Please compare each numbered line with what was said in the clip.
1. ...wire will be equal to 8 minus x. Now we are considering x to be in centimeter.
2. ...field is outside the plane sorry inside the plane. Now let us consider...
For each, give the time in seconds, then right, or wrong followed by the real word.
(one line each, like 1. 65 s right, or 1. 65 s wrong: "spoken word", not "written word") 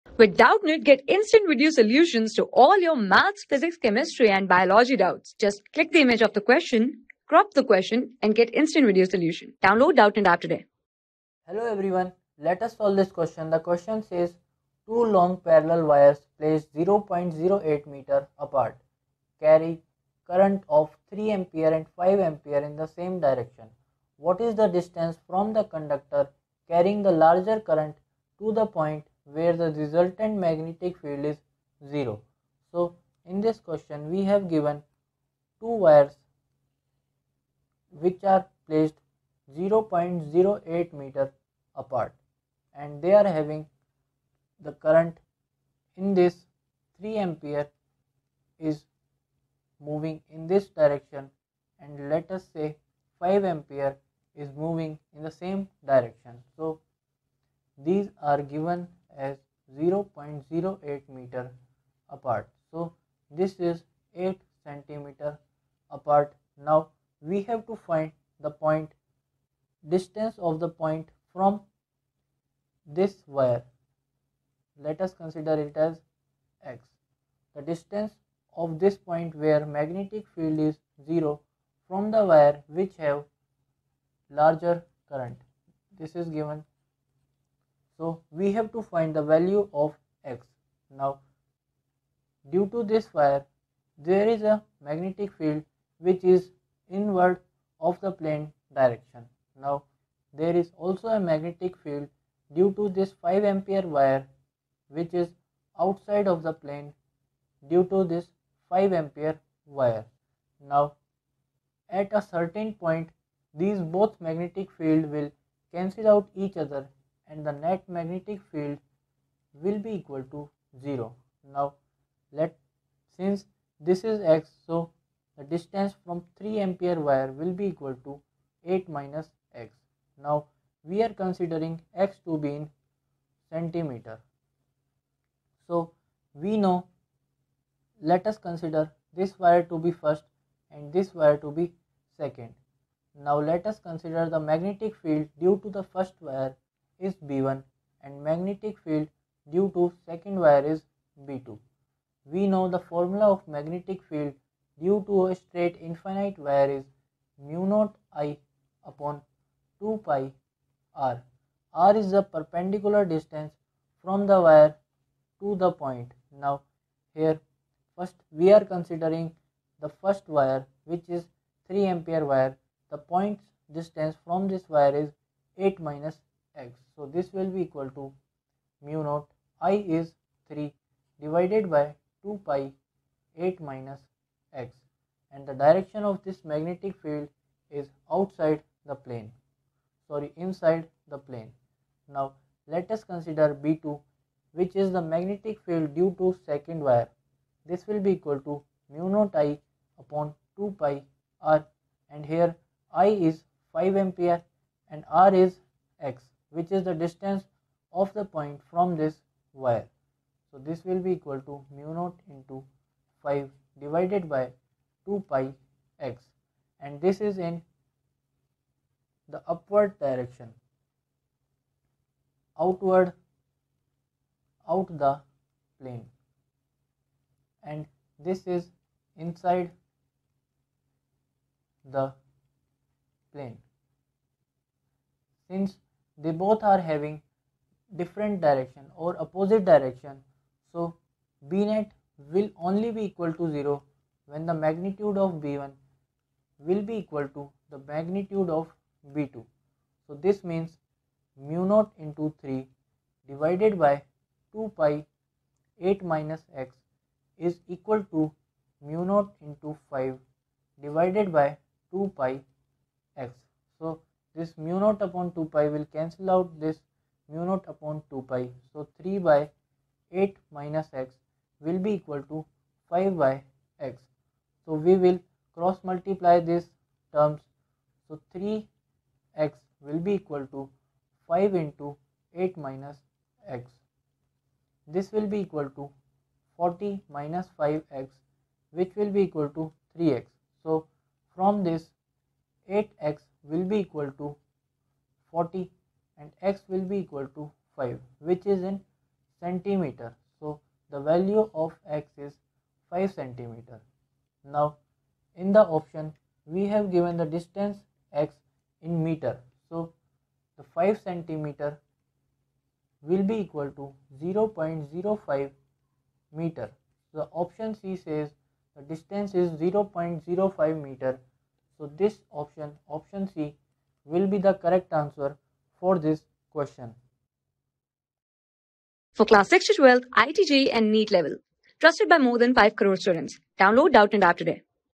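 1. 127 s right
2. 187 s right.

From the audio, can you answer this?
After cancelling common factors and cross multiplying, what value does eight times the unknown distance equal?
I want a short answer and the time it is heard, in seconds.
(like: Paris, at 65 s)
40, at 292 s.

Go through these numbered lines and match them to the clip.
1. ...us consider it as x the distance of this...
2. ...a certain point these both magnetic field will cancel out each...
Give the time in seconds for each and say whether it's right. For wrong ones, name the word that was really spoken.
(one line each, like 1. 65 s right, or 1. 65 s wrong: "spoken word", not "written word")
1. 75 s right
2. 112 s right.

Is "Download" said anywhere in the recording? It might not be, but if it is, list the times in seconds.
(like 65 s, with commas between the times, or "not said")
9 s, 333 s.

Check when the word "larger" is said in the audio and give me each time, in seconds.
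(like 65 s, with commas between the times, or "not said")
27 s, 84 s.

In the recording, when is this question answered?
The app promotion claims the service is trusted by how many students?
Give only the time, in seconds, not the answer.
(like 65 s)
332 s.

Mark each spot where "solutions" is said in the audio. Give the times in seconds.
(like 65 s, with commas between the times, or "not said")
1 s, 9 s.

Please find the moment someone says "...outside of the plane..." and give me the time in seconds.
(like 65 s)
105 s.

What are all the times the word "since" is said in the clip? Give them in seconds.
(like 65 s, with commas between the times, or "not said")
123 s, 235 s.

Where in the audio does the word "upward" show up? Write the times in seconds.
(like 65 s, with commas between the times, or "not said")
219 s.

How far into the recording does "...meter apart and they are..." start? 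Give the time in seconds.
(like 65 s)
40 s.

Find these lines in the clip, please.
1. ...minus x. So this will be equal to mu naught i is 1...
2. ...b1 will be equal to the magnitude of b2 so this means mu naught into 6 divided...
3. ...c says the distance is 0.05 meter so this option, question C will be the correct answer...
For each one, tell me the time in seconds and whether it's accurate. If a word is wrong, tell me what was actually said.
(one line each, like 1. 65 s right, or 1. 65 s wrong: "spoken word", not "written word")
1. 175 s wrong: "3", not "1"
2. 245 s wrong: "3", not "6"
3. 317 s wrong: "option", not "question".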